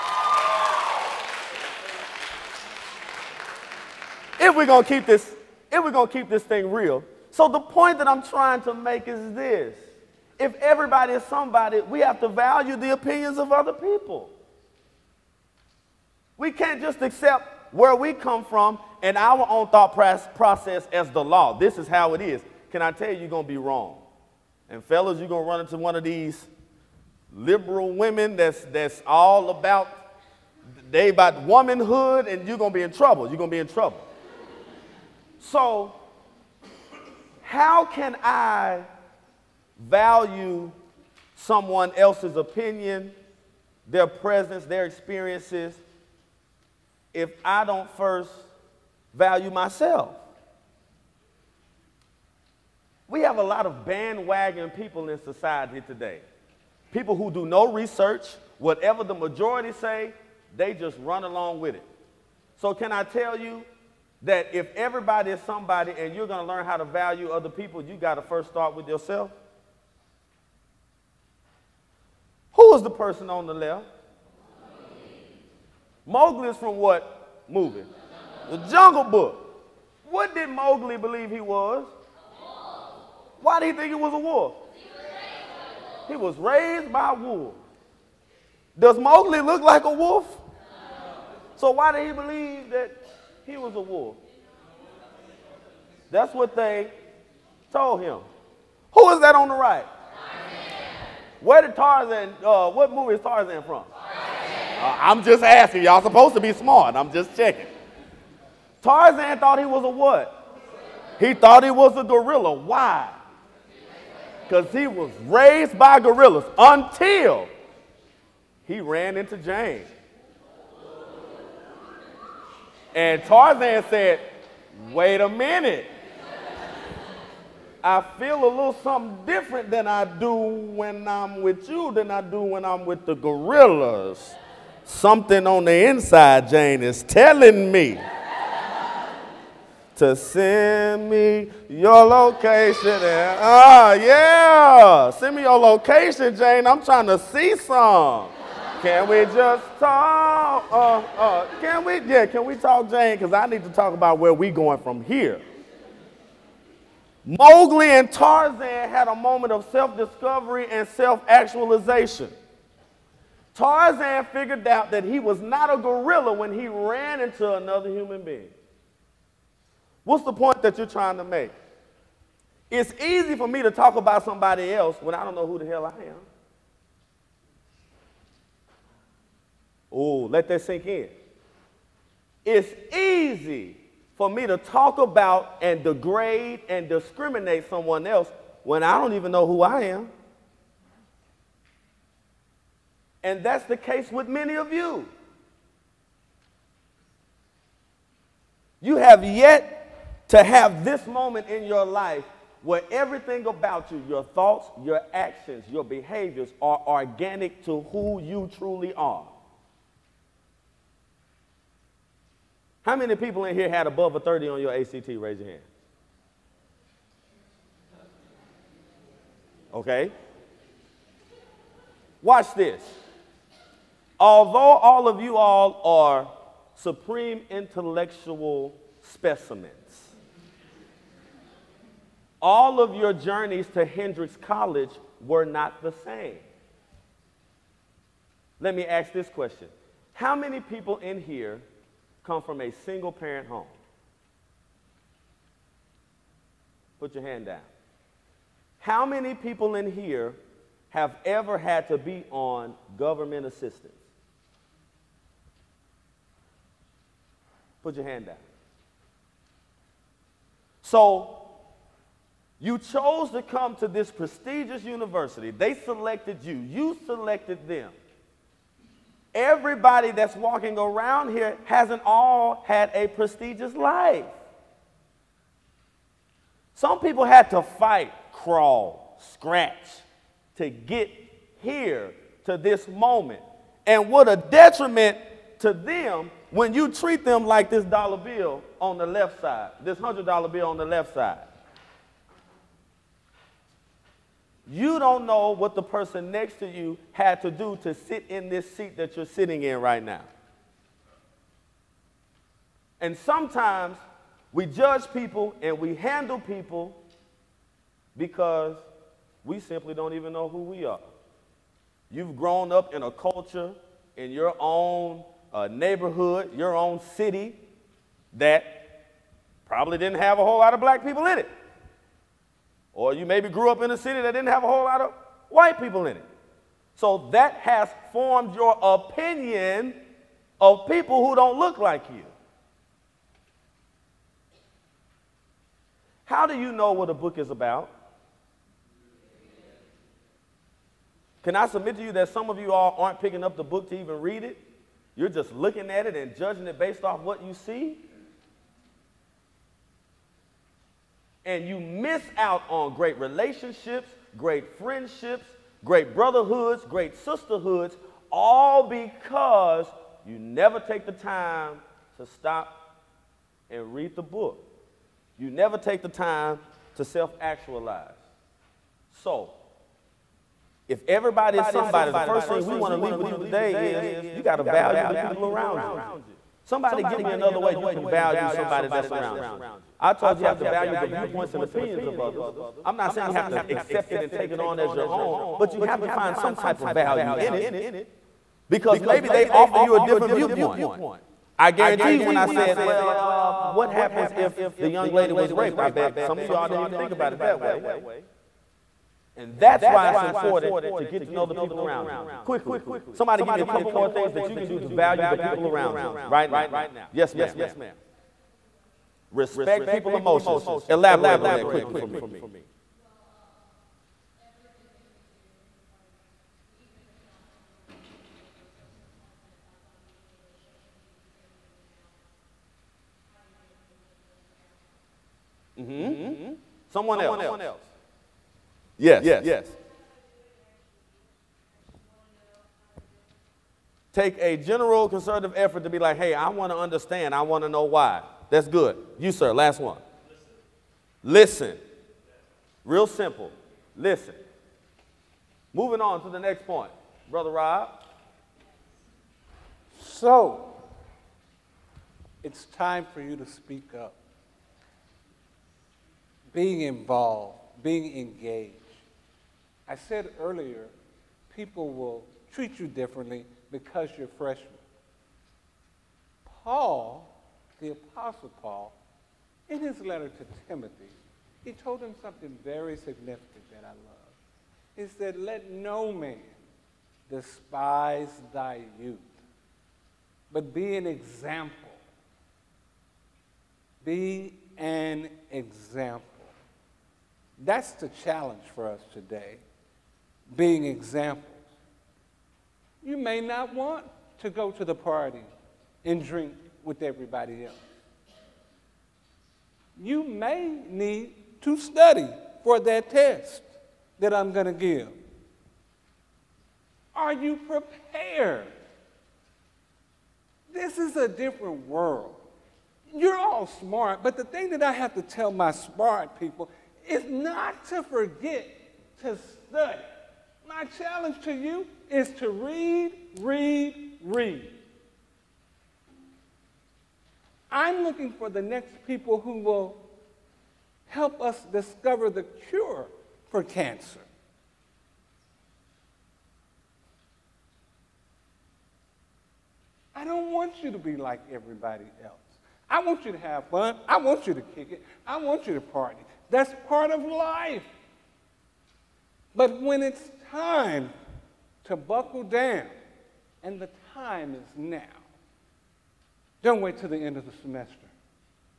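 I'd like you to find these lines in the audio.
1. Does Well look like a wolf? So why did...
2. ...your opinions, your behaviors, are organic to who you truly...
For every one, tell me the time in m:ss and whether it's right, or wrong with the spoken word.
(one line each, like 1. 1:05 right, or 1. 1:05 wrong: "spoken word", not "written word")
1. 1:28 wrong: "Mowgli", not "Well"
2. 3:24 wrong: "actions", not "opinions".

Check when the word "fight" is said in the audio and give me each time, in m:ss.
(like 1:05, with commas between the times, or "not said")
4:37.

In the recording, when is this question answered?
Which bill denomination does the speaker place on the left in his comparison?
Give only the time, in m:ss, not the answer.
4:49.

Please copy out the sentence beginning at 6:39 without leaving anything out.
And that's why it's important to get to know the people around you quickly.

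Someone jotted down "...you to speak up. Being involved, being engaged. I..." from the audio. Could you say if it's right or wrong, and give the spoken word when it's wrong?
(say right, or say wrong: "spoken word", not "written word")
right.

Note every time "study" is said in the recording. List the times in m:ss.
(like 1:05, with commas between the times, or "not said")
8:21, 8:39.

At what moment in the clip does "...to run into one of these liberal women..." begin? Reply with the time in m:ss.
0:25.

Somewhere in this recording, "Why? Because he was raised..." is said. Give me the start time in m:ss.
1:52.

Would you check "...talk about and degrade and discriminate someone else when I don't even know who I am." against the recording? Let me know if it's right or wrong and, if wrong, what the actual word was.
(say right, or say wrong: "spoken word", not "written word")
right.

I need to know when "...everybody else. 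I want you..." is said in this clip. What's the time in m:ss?
9:01.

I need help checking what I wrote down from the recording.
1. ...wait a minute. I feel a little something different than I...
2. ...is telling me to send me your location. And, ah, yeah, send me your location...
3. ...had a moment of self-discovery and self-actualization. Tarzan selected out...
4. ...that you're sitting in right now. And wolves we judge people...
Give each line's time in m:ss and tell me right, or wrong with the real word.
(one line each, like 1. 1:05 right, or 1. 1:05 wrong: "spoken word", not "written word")
1. 2:04 right
2. 2:16 right
3. 2:38 wrong: "figured", not "selected"
4. 4:58 wrong: "sometimes", not "wolves".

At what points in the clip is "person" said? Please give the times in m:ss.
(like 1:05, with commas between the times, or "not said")
1:12, 4:55.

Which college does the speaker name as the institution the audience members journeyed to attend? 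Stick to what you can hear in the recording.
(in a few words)
Hendrix College.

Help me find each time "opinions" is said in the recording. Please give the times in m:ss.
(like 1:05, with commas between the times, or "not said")
0:12, 0:42, 5:28, 6:21.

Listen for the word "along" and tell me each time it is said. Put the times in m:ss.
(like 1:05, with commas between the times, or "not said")
1:01.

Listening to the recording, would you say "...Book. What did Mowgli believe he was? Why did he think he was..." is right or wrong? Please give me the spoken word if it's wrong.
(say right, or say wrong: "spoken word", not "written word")
right.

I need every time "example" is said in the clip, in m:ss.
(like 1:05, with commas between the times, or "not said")
8:01, 8:05, 8:10.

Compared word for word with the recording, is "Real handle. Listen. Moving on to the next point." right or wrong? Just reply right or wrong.
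wrong.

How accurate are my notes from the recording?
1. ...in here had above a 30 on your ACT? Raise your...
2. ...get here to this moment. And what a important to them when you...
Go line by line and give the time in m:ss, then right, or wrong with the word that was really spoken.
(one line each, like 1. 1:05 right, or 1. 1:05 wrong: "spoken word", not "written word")
1. 3:33 right
2. 4:40 wrong: "detriment", not "important".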